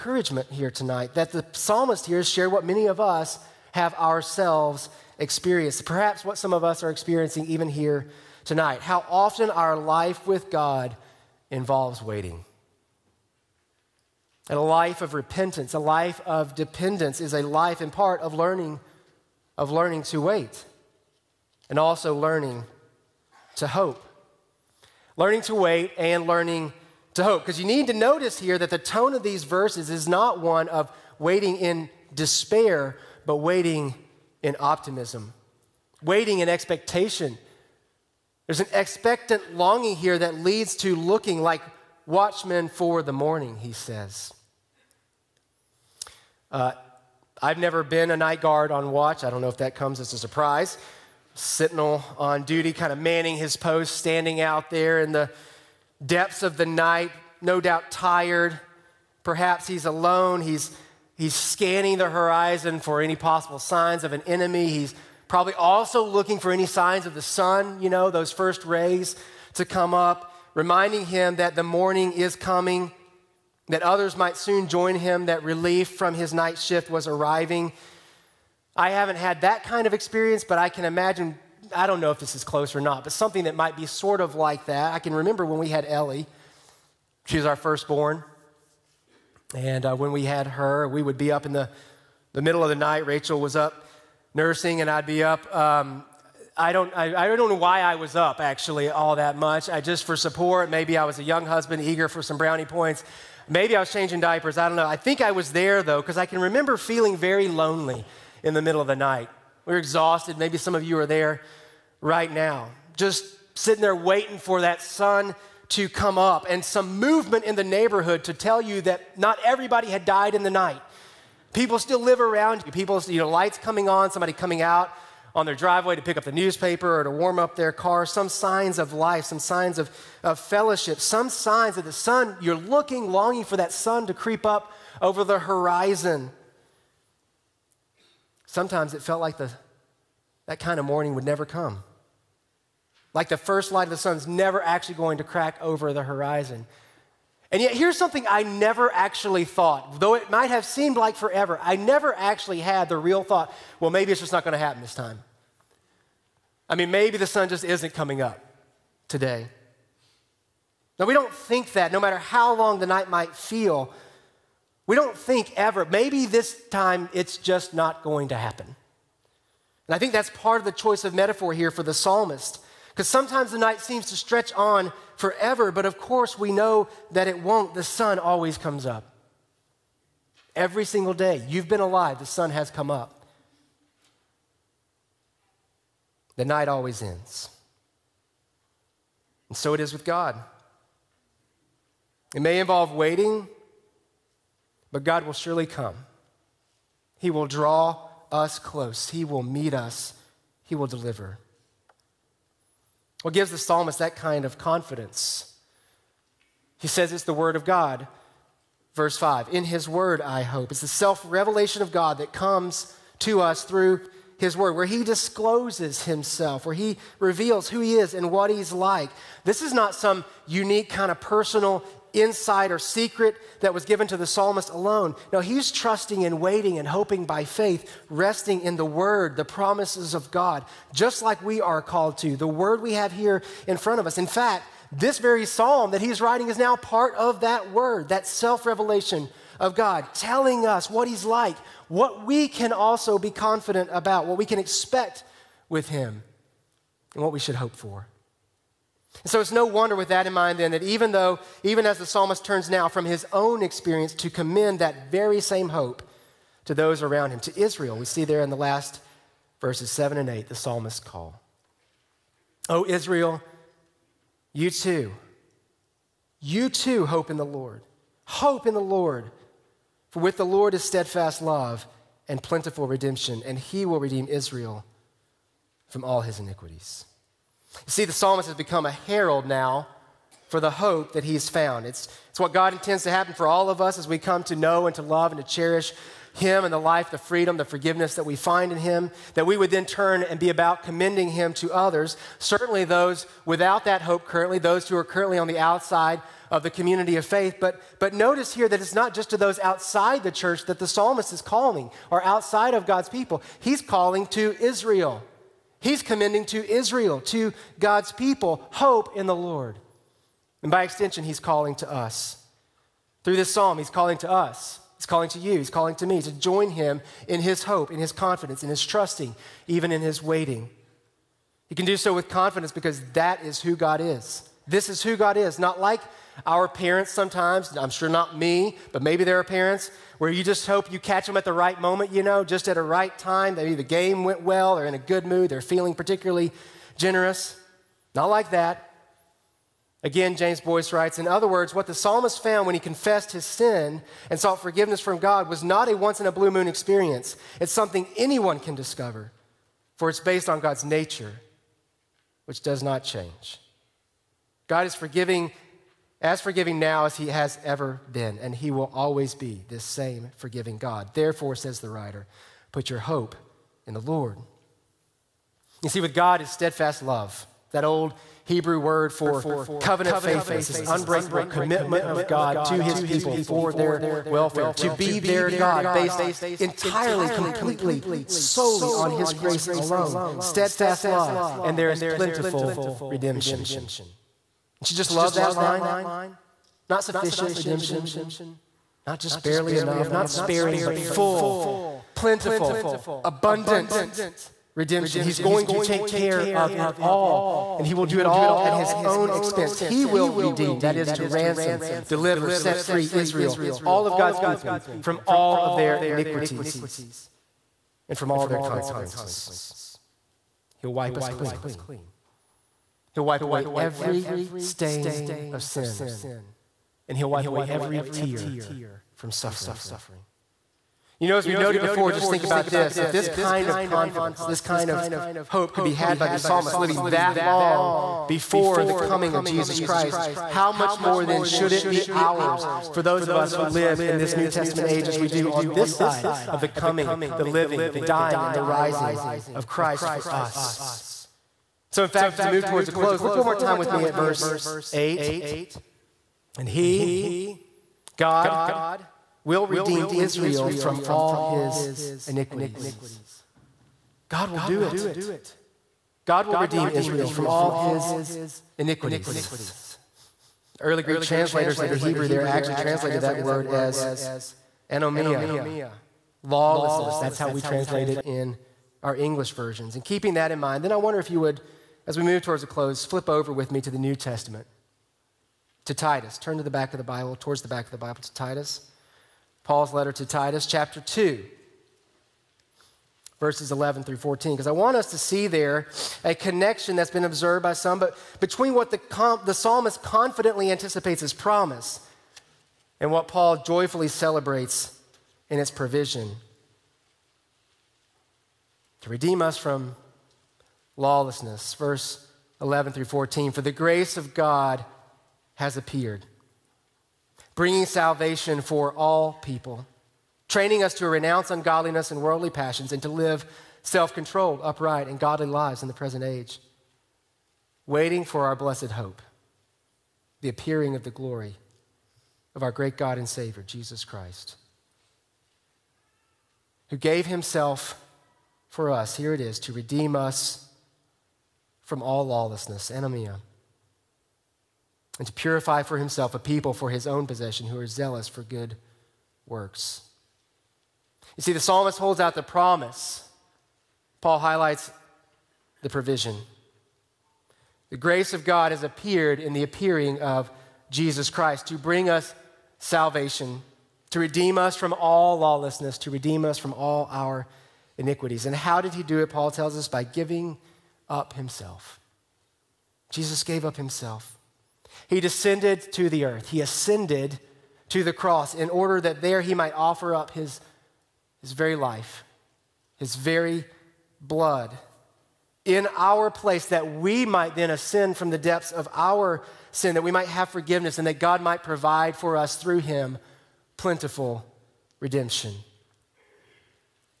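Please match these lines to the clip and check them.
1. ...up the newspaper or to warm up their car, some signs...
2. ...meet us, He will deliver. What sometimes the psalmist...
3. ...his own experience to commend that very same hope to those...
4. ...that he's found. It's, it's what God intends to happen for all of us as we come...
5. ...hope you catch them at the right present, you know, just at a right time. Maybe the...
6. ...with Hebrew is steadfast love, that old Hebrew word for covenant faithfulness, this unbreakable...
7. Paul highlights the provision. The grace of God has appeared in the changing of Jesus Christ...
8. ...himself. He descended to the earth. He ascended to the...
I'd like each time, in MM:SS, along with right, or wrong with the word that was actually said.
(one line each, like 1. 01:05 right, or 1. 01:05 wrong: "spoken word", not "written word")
1. 02:06 right
2. 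03:19 wrong: "gives", not "sometimes"
3. 04:13 right
4. 04:41 right
5. 05:30 wrong: "moment", not "present"
6. 06:06 wrong: "God", not "Hebrew"
7. 09:04 wrong: "appearing", not "changing"
8. 09:23 right.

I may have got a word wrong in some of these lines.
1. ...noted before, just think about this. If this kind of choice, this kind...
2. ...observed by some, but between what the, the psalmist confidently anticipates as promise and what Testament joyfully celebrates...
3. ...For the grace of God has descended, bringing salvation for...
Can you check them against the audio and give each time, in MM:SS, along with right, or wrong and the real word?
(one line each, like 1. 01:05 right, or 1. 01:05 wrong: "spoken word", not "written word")
1. 07:01 wrong: "confidence", not "choice"
2. 08:07 wrong: "Paul", not "Testament"
3. 08:23 wrong: "appeared", not "descended".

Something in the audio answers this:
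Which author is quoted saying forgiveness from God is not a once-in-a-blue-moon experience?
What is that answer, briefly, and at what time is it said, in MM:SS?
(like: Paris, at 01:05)
James Boice, at 05:40.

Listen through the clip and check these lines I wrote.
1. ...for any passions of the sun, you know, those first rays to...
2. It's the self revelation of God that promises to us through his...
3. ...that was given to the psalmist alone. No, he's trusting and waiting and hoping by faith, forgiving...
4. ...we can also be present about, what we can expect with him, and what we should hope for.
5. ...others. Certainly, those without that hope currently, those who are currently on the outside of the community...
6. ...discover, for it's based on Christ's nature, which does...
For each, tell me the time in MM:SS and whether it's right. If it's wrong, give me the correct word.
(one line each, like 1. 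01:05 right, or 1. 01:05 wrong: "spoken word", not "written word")
1. 01:06 wrong: "signs", not "passions"
2. 03:30 wrong: "comes", not "promises"
3. 03:43 wrong: "resting", not "forgiving"
4. 04:02 wrong: "confident", not "present"
5. 04:51 right
6. 05:48 wrong: "God", not "Christ".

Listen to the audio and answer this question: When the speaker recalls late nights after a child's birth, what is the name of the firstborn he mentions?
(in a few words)
Ellie.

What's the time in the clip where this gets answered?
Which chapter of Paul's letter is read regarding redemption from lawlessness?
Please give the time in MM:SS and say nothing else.
08:00.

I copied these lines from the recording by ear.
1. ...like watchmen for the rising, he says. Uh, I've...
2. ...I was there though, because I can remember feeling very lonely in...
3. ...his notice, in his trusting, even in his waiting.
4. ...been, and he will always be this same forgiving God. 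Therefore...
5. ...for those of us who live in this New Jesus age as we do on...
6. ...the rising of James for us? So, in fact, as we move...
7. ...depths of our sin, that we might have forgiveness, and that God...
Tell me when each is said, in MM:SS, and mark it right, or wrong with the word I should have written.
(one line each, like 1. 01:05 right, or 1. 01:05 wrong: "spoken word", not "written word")
1. 00:41 wrong: "morning", not "rising"
2. 01:45 right
3. 05:17 wrong: "confidence", not "notice"
4. 05:58 right
5. 07:12 wrong: "Testament", not "Jesus"
6. 07:18 wrong: "Christ", not "James"
7. 09:38 right.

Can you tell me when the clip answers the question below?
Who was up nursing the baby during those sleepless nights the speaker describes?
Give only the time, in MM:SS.
01:33.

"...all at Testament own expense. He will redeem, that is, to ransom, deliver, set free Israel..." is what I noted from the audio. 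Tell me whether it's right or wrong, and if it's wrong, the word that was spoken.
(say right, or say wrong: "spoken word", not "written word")
wrong: "His", not "Testament".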